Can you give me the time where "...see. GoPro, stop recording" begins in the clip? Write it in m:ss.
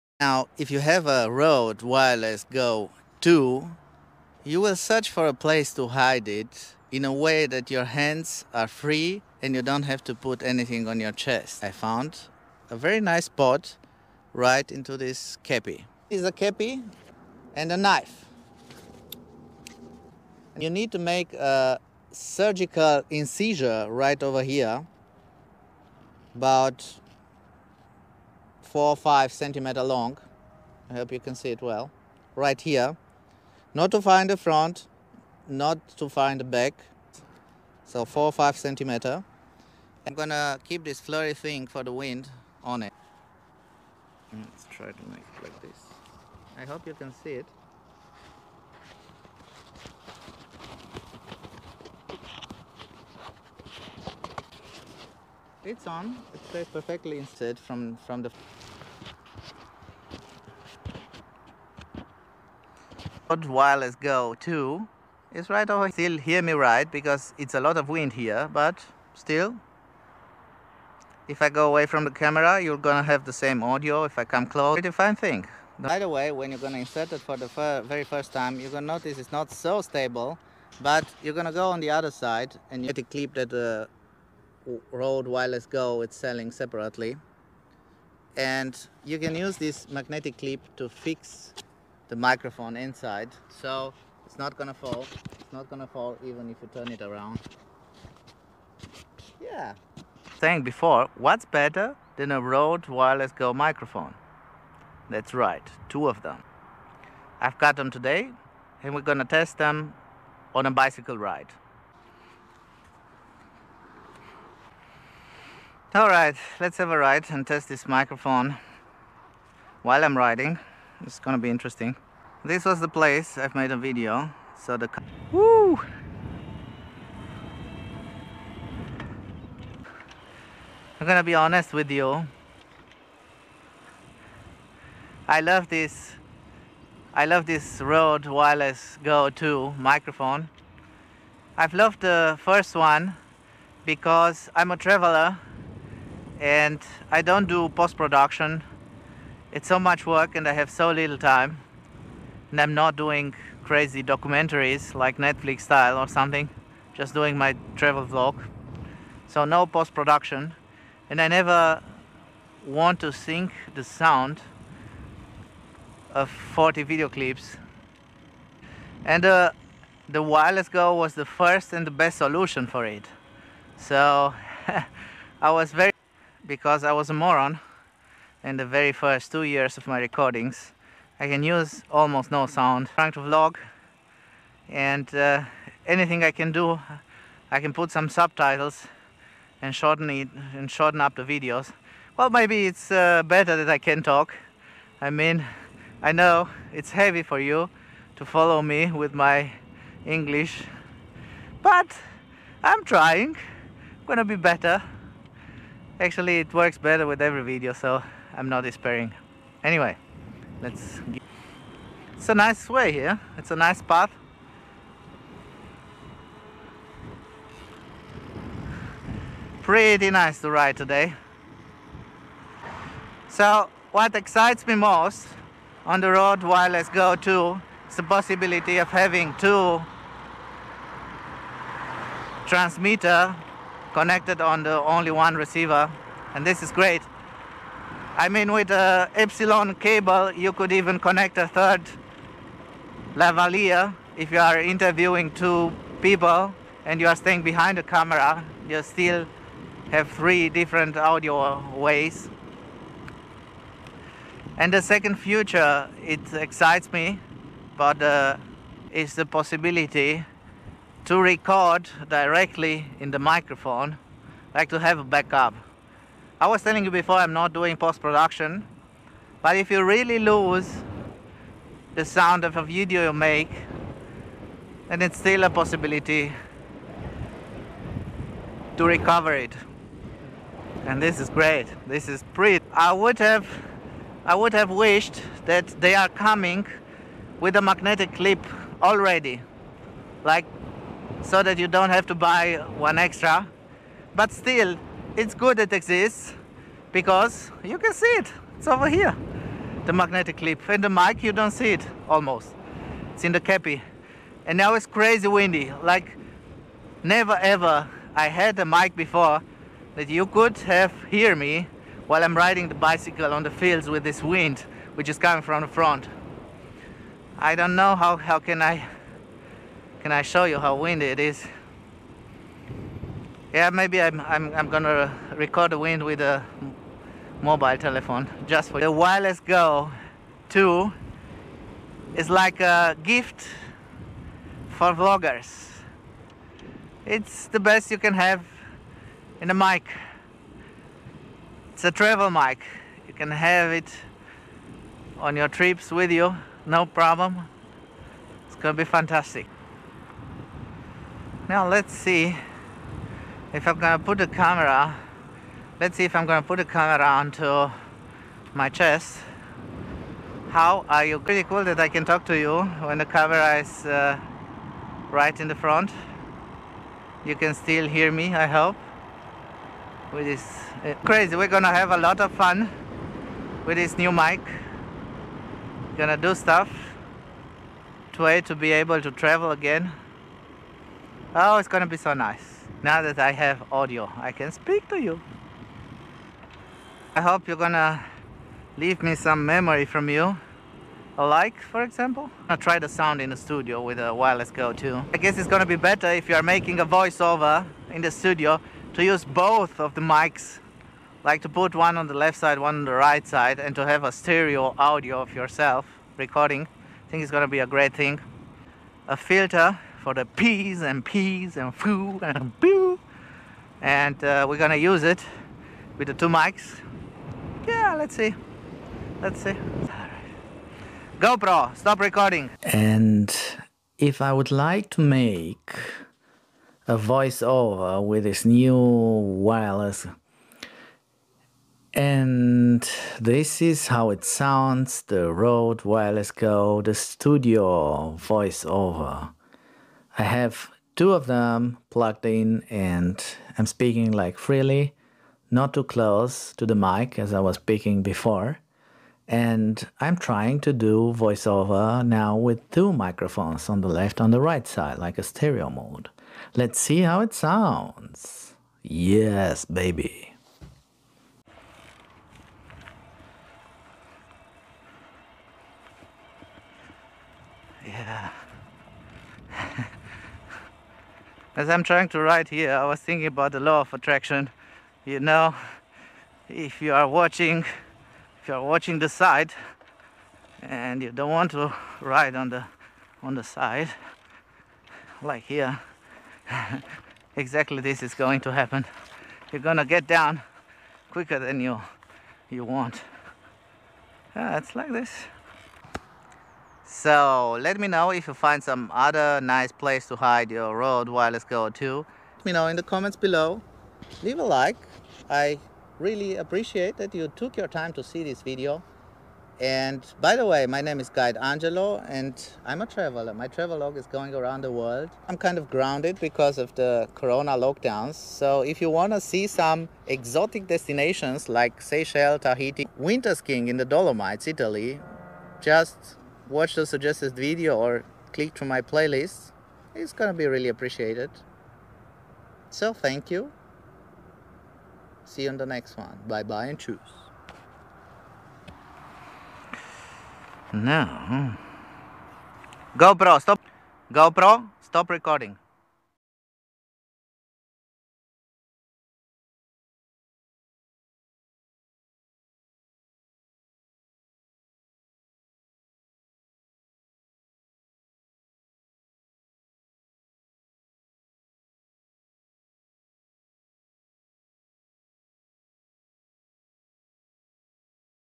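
6:59.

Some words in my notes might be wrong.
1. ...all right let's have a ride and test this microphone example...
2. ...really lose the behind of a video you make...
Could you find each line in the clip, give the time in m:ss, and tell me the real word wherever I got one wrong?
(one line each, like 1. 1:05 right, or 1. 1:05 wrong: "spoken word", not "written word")
1. 1:55 wrong: "while", not "example"
2. 4:29 wrong: "sound", not "behind".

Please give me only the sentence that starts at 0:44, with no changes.
Mm, let's try to make it like this.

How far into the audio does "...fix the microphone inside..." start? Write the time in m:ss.
1:30.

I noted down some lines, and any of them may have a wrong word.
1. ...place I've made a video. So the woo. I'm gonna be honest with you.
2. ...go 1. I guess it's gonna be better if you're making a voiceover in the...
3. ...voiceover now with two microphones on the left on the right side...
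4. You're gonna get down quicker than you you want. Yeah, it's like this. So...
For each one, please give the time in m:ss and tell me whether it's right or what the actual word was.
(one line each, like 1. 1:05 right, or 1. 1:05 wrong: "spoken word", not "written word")
1. 2:02 right
2. 6:34 wrong: "2", not "1"
3. 7:31 right
4. 8:09 right.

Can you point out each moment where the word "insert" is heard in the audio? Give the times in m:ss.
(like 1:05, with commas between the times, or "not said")
1:16.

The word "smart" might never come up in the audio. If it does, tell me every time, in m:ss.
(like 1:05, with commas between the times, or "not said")
not said.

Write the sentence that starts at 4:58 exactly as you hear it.
It's over here, the magnetic clip.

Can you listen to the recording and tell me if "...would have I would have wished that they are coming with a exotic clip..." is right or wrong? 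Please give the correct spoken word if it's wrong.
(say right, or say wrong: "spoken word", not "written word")
wrong: "magnetic", not "exotic".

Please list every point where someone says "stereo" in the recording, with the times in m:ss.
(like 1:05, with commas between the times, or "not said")
6:44, 7:35.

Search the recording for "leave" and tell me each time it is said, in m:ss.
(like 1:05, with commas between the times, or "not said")
6:28, 8:24.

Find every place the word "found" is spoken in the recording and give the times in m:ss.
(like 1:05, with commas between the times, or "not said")
0:11.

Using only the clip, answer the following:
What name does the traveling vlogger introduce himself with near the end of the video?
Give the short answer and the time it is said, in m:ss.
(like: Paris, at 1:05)
Guide Angelo, at 8:31.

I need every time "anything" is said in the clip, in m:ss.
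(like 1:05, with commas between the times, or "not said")
0:10, 3:05.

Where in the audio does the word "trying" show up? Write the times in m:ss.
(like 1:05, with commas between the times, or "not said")
3:03, 3:22, 7:30, 7:51.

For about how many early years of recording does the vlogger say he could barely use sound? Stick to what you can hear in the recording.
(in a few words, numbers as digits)
2.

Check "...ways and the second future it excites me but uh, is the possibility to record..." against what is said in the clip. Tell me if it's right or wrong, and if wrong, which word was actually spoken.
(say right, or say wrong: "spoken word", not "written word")
right.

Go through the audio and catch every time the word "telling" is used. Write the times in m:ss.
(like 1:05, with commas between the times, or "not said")
4:26.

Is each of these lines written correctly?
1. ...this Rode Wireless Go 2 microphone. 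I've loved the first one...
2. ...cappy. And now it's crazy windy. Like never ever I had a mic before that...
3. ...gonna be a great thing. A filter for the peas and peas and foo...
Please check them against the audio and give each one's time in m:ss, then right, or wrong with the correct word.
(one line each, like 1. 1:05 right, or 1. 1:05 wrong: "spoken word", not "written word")
1. 2:17 right
2. 5:03 right
3. 6:47 right.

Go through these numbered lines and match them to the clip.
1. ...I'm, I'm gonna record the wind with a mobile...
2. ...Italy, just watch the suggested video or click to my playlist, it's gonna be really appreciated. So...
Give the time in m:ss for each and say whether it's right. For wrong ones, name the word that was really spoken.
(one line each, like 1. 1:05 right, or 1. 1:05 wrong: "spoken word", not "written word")
1. 5:24 right
2. 8:44 right.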